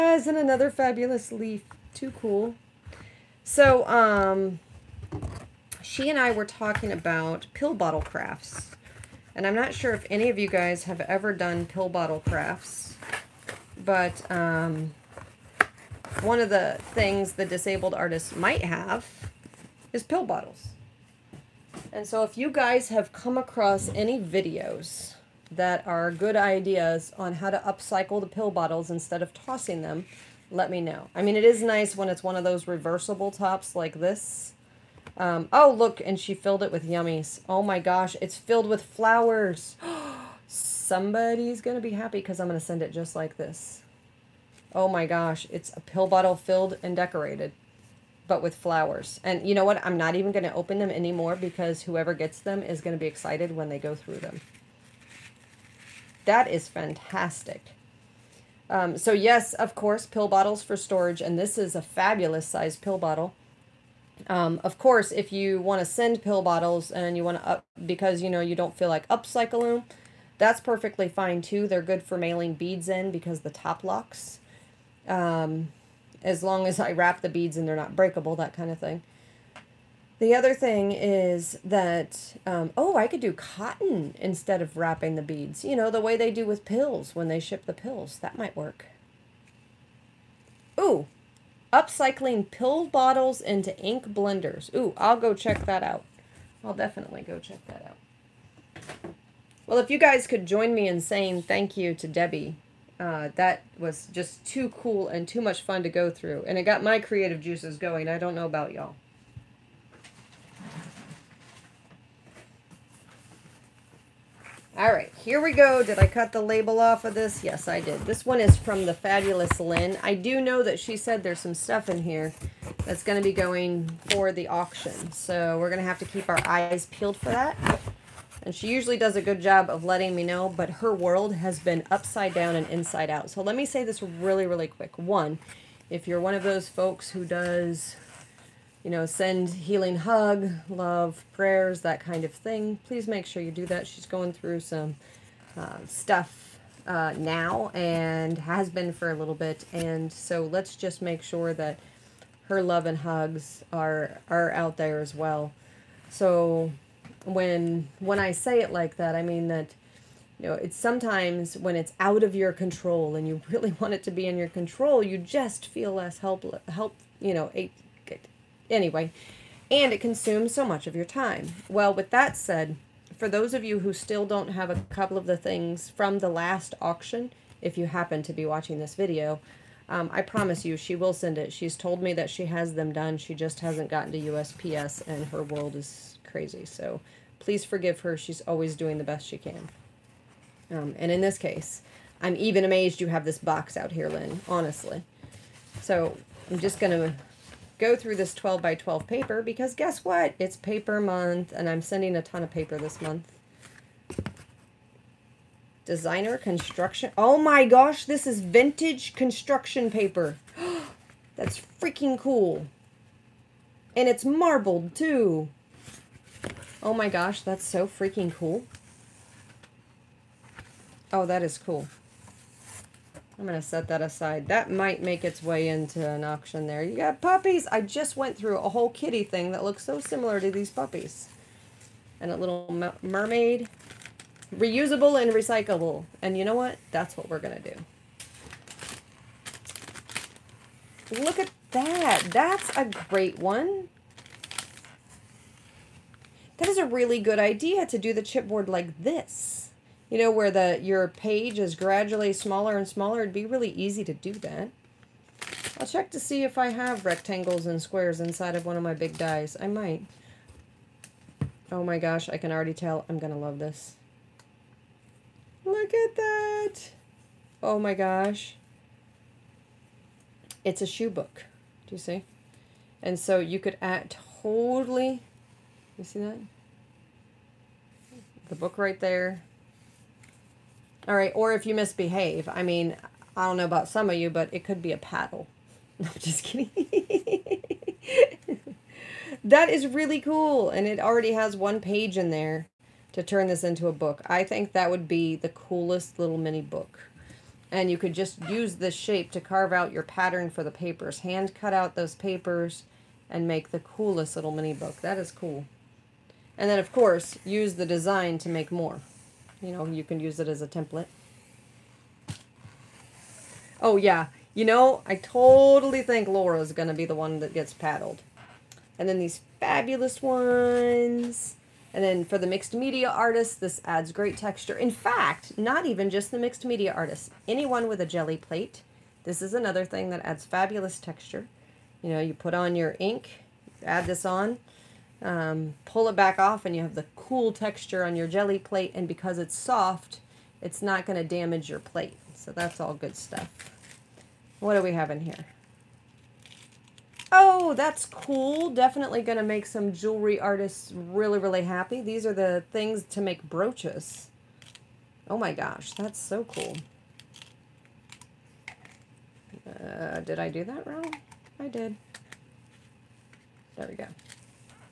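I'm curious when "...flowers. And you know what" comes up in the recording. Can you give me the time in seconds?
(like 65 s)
48 s.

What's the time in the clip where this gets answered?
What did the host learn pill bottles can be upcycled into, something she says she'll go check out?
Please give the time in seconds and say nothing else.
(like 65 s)
93 s.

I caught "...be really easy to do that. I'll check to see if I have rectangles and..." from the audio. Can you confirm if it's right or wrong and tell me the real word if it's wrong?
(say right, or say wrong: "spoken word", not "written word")
right.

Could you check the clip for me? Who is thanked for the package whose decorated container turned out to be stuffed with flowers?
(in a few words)
Debby.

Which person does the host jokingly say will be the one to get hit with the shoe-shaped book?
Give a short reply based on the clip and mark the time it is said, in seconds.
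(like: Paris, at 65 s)
Laura, at 316 s.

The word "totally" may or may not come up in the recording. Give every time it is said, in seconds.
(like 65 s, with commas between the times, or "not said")
274 s, 315 s.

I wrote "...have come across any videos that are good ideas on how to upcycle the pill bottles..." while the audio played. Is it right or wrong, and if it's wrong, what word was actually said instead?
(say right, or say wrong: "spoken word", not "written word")
right.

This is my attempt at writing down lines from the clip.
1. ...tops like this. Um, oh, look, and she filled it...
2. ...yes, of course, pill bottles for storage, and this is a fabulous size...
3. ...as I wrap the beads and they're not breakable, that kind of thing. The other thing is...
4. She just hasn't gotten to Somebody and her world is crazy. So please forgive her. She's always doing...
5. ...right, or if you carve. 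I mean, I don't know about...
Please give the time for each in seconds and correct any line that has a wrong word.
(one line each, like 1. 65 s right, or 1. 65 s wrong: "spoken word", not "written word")
1. 33 s right
2. 59 s right
3. 76 s right
4. 183 s wrong: "USPS", not "Somebody"
5. 281 s wrong: "misbehave", not "carve".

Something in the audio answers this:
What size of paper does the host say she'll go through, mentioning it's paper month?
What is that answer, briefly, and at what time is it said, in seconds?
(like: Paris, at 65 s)
12 by 12, at 198 s.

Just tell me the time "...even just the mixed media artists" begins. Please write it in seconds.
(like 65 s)
325 s.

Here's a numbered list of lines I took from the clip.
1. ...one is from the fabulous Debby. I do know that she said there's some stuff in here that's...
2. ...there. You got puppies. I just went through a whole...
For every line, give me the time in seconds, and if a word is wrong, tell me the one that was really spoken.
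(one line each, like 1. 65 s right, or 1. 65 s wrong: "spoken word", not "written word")
1. 118 s wrong: "Lynne", not "Debby"
2. 226 s right.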